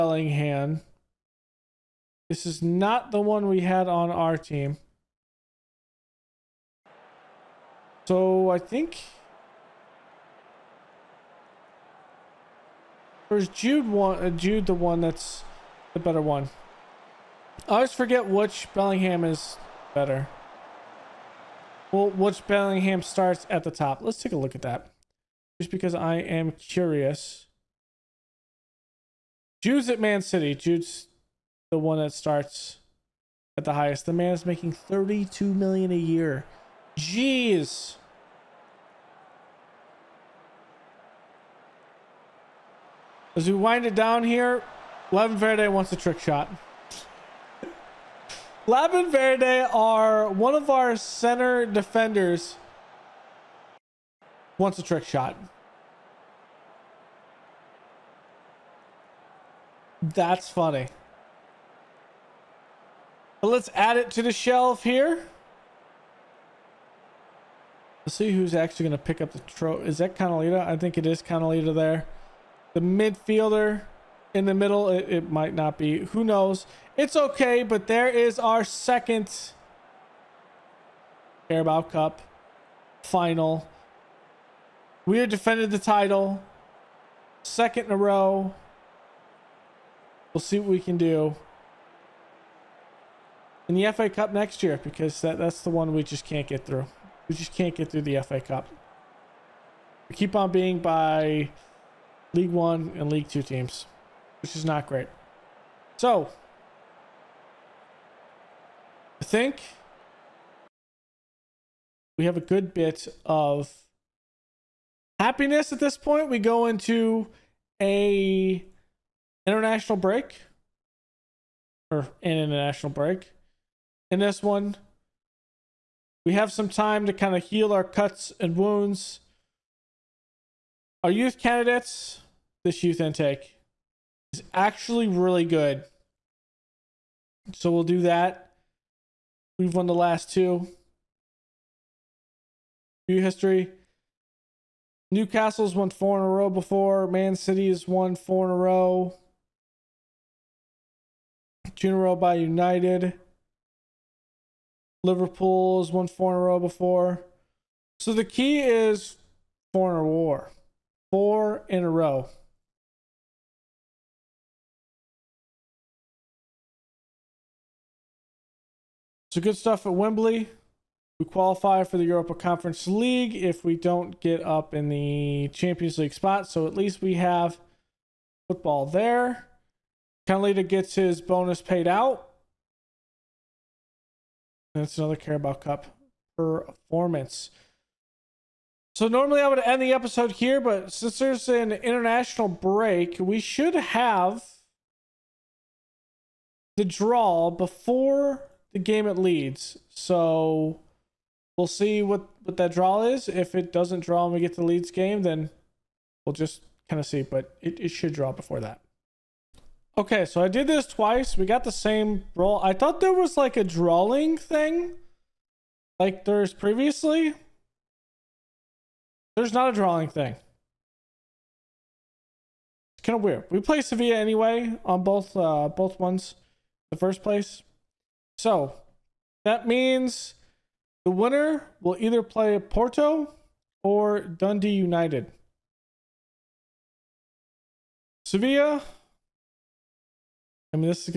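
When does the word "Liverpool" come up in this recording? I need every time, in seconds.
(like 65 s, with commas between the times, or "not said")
155 s.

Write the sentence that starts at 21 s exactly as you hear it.
Well, which Bellingham starts at the top.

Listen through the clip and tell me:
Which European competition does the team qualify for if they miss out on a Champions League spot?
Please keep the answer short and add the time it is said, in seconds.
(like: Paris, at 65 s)
Europa Conference League, at 172 s.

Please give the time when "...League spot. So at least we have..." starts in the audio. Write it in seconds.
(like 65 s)
175 s.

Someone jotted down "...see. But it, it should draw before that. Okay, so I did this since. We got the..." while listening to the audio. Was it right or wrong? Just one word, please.
wrong.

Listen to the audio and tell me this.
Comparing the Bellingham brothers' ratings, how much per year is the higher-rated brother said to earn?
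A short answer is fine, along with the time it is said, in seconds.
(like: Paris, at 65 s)
32 million, at 34 s.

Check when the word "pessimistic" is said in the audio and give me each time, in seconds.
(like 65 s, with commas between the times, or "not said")
not said.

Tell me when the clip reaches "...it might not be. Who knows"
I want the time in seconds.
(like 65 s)
75 s.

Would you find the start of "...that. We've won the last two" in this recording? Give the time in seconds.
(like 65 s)
138 s.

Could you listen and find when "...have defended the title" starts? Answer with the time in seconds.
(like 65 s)
85 s.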